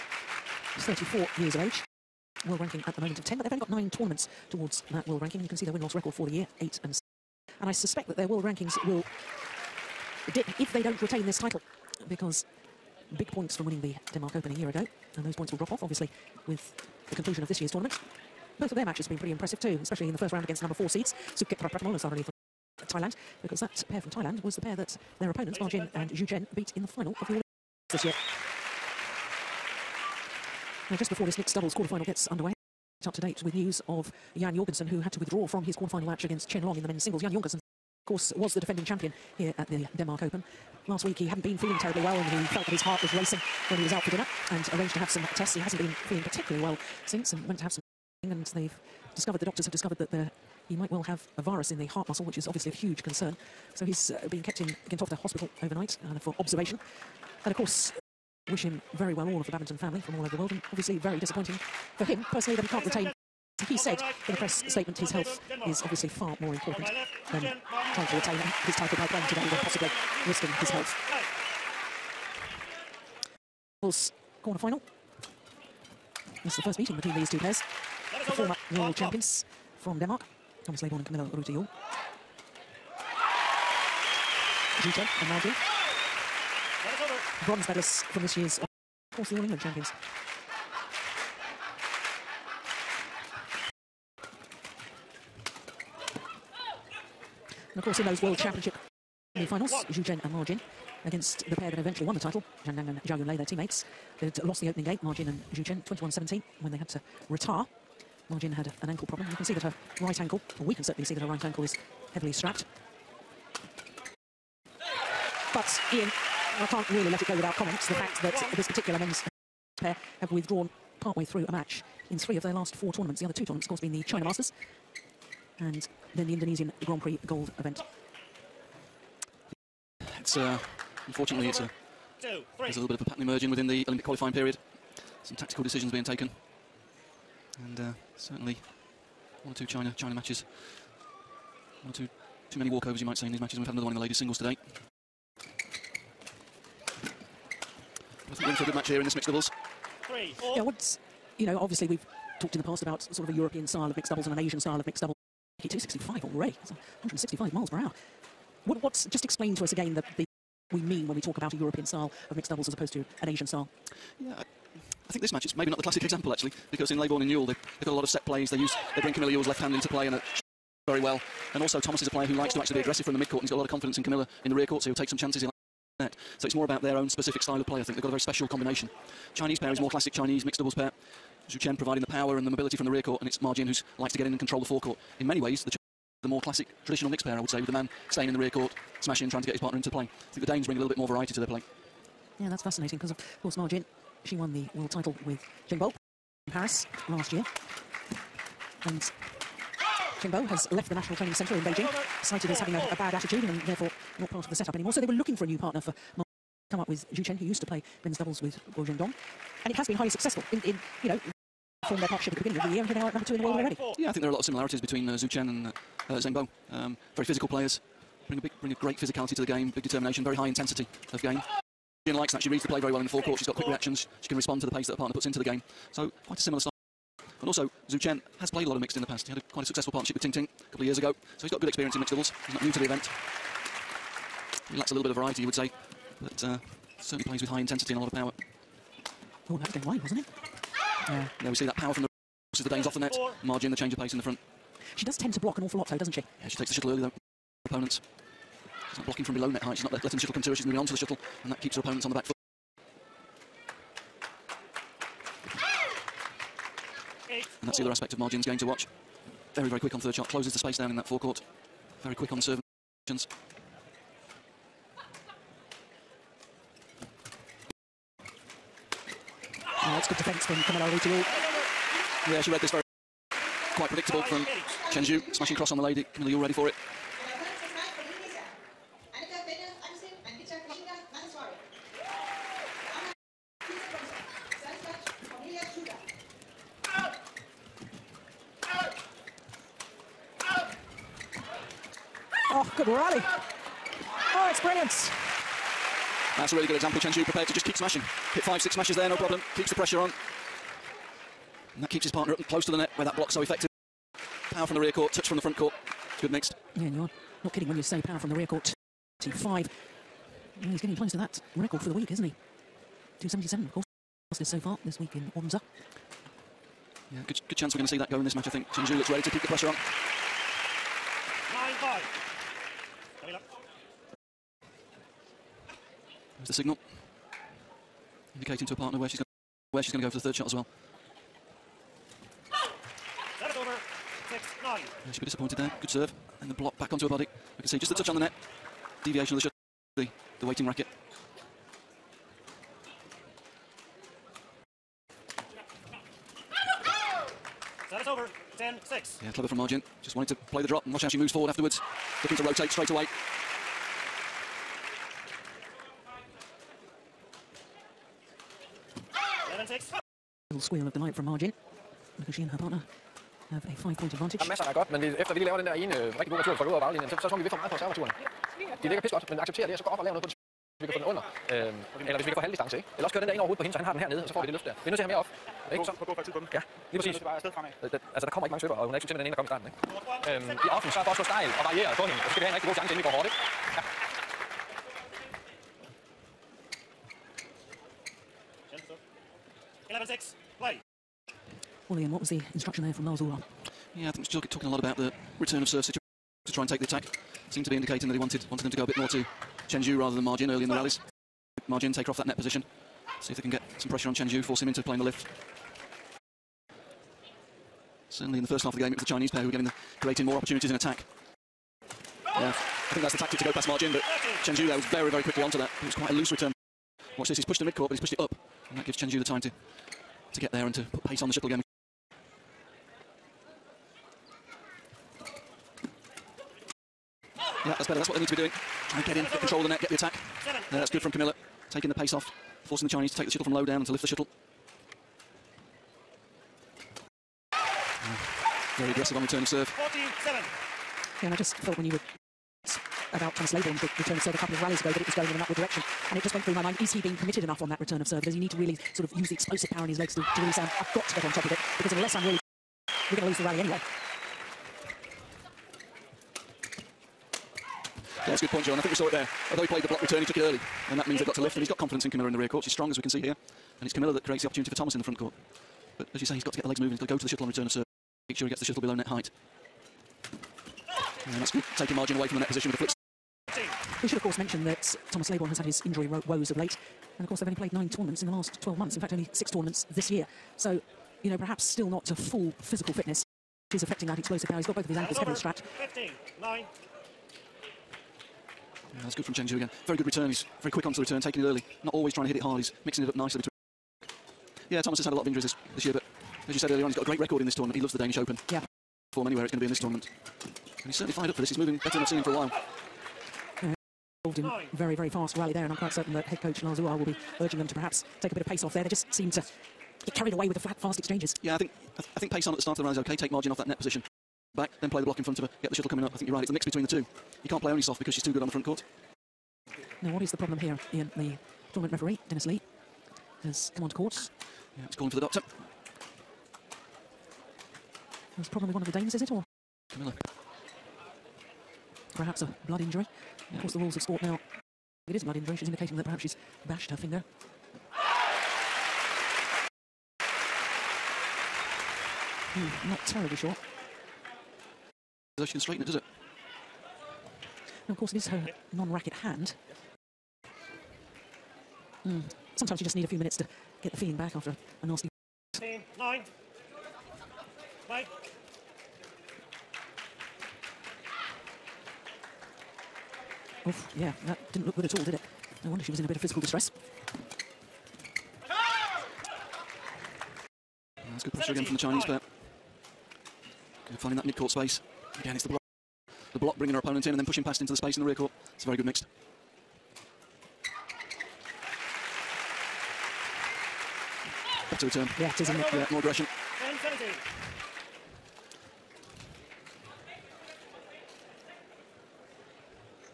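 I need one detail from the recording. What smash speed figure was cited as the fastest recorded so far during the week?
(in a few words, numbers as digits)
277.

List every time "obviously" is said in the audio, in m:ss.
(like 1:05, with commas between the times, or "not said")
0:15, 0:52, 1:00, 1:05, 2:31.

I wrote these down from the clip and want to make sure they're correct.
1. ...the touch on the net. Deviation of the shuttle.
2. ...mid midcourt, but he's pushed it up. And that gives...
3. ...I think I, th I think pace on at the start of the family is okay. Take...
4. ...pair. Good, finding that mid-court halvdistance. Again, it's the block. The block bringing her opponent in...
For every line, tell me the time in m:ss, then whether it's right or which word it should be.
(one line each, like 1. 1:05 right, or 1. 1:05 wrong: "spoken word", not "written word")
1. 5:37 right
2. 6:57 right
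3. 8:31 wrong: "rally", not "family"
4. 9:32 wrong: "space", not "halvdistance".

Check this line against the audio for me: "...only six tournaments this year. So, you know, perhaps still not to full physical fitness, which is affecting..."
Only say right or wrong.
right.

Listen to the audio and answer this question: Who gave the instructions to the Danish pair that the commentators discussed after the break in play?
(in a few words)
Lars Ulrich.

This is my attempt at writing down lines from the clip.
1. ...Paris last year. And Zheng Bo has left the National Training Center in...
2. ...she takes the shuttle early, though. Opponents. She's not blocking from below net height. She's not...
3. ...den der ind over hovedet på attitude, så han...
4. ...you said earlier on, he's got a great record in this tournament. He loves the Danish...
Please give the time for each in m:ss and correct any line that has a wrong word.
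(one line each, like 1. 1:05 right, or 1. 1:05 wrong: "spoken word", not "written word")
1. 3:16 right
2. 4:06 right
3. 6:13 wrong: "hende", not "attitude"
4. 8:16 right.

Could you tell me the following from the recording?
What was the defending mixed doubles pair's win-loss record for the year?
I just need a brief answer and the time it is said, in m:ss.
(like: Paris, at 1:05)
8 and 6, at 0:06.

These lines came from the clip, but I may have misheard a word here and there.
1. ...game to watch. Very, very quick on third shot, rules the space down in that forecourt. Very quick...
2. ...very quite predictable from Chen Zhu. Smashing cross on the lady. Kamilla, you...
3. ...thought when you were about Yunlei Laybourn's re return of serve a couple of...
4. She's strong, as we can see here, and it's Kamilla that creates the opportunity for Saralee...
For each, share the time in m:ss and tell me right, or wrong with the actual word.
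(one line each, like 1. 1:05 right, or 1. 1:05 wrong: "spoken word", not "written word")
1. 4:18 wrong: "closes", not "rules"
2. 4:32 right
3. 7:21 wrong: "Thomas", not "Yunlei"
4. 7:42 wrong: "Thomas", not "Saralee".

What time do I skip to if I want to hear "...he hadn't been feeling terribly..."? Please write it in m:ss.
0:41.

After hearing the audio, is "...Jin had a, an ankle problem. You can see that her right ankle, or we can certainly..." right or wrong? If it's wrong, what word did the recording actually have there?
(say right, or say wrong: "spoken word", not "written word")
right.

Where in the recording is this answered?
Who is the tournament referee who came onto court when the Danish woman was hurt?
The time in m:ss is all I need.
8:42.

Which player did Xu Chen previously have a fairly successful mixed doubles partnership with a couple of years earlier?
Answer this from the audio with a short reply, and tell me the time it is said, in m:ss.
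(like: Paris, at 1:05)
Ting Ting, at 3:50.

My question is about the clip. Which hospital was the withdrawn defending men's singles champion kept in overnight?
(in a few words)
Gentofte Hospital.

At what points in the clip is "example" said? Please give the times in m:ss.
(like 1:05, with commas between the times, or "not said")
2:46, 4:56.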